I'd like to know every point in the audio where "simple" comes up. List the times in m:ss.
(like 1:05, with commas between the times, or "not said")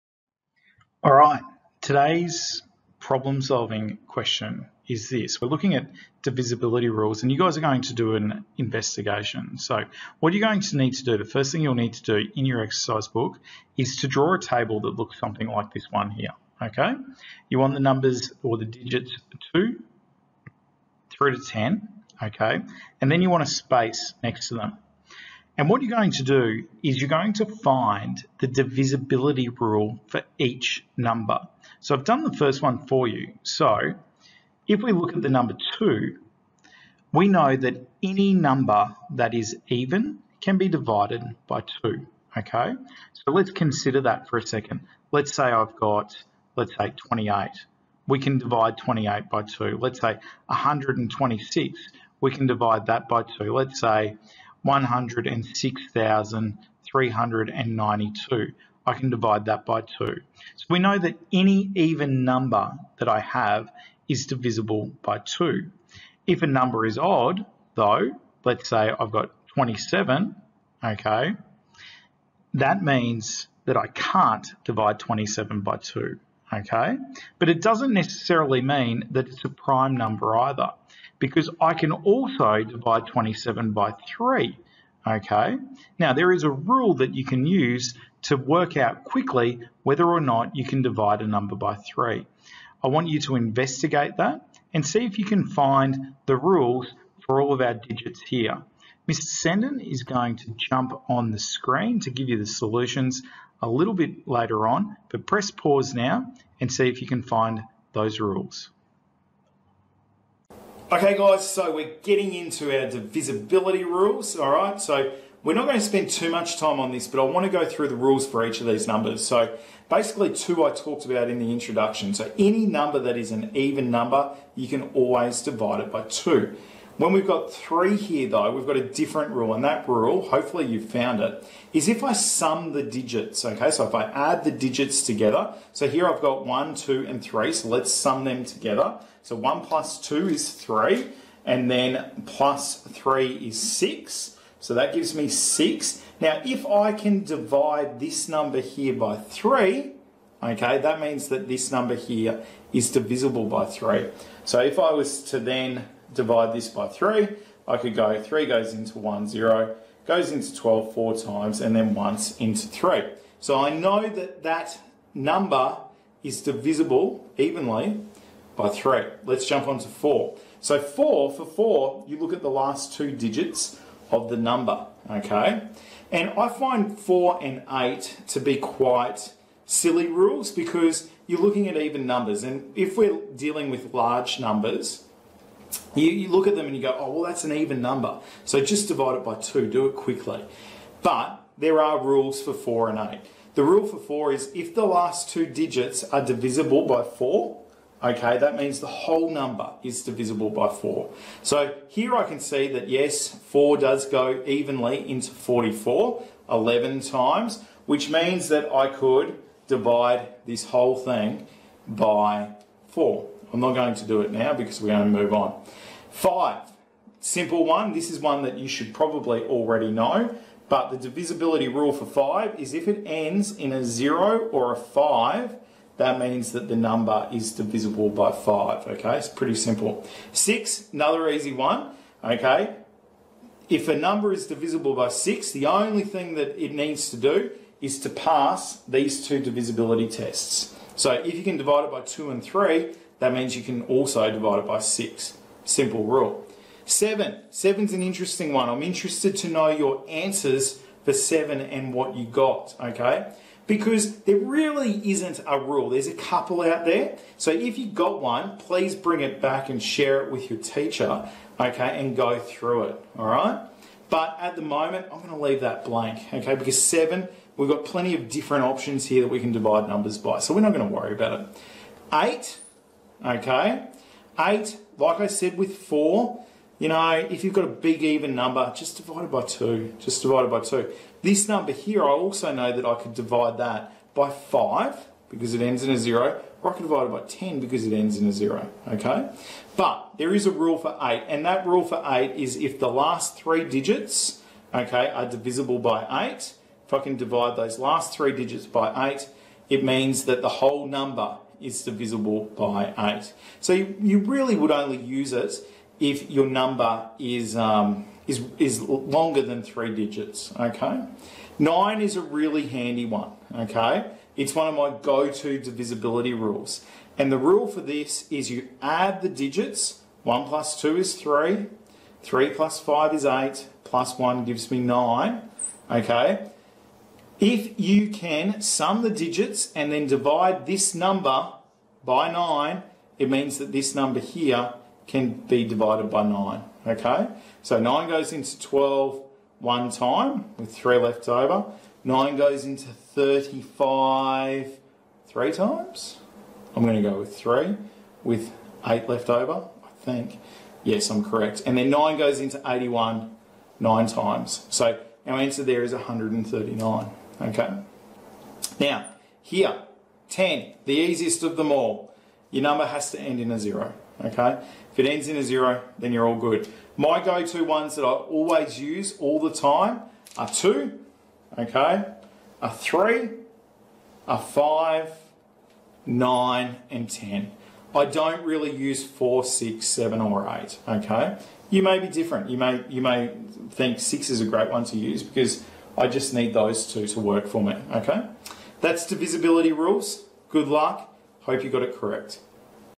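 3:37, 3:49, 4:05.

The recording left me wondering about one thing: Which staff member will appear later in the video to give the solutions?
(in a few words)
Mr. Senden.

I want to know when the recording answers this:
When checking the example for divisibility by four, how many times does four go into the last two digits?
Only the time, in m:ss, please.
3:26.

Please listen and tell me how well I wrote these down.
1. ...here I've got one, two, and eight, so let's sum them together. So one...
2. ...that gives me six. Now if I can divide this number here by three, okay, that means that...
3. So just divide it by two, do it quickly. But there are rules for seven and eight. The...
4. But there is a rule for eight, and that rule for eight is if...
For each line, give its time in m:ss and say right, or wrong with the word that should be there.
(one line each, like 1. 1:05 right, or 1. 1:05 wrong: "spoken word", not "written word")
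1. 2:15 wrong: "three", not "eight"
2. 2:24 right
3. 3:08 wrong: "four", not "seven"
4. 4:49 right.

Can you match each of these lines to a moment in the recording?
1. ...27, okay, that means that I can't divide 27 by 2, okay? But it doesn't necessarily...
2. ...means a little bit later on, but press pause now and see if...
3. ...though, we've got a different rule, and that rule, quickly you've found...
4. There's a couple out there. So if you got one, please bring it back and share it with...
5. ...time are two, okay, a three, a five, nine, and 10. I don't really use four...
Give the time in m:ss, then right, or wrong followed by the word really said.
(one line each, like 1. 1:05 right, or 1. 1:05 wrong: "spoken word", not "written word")
1. 1:09 right
2. 1:42 wrong: "solutions", not "means"
3. 2:08 wrong: "hopefully", not "quickly"
4. 4:15 right
5. 6:09 right.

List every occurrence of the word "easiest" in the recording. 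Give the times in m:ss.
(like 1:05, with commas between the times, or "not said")
6:00.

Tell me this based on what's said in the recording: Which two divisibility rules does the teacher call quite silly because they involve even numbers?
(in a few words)
4 and 8.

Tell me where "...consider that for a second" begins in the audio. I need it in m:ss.
0:43.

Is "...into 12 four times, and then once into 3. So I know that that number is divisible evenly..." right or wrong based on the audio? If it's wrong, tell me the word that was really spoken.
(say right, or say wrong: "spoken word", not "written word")
right.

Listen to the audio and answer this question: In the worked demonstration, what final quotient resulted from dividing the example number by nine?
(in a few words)
139.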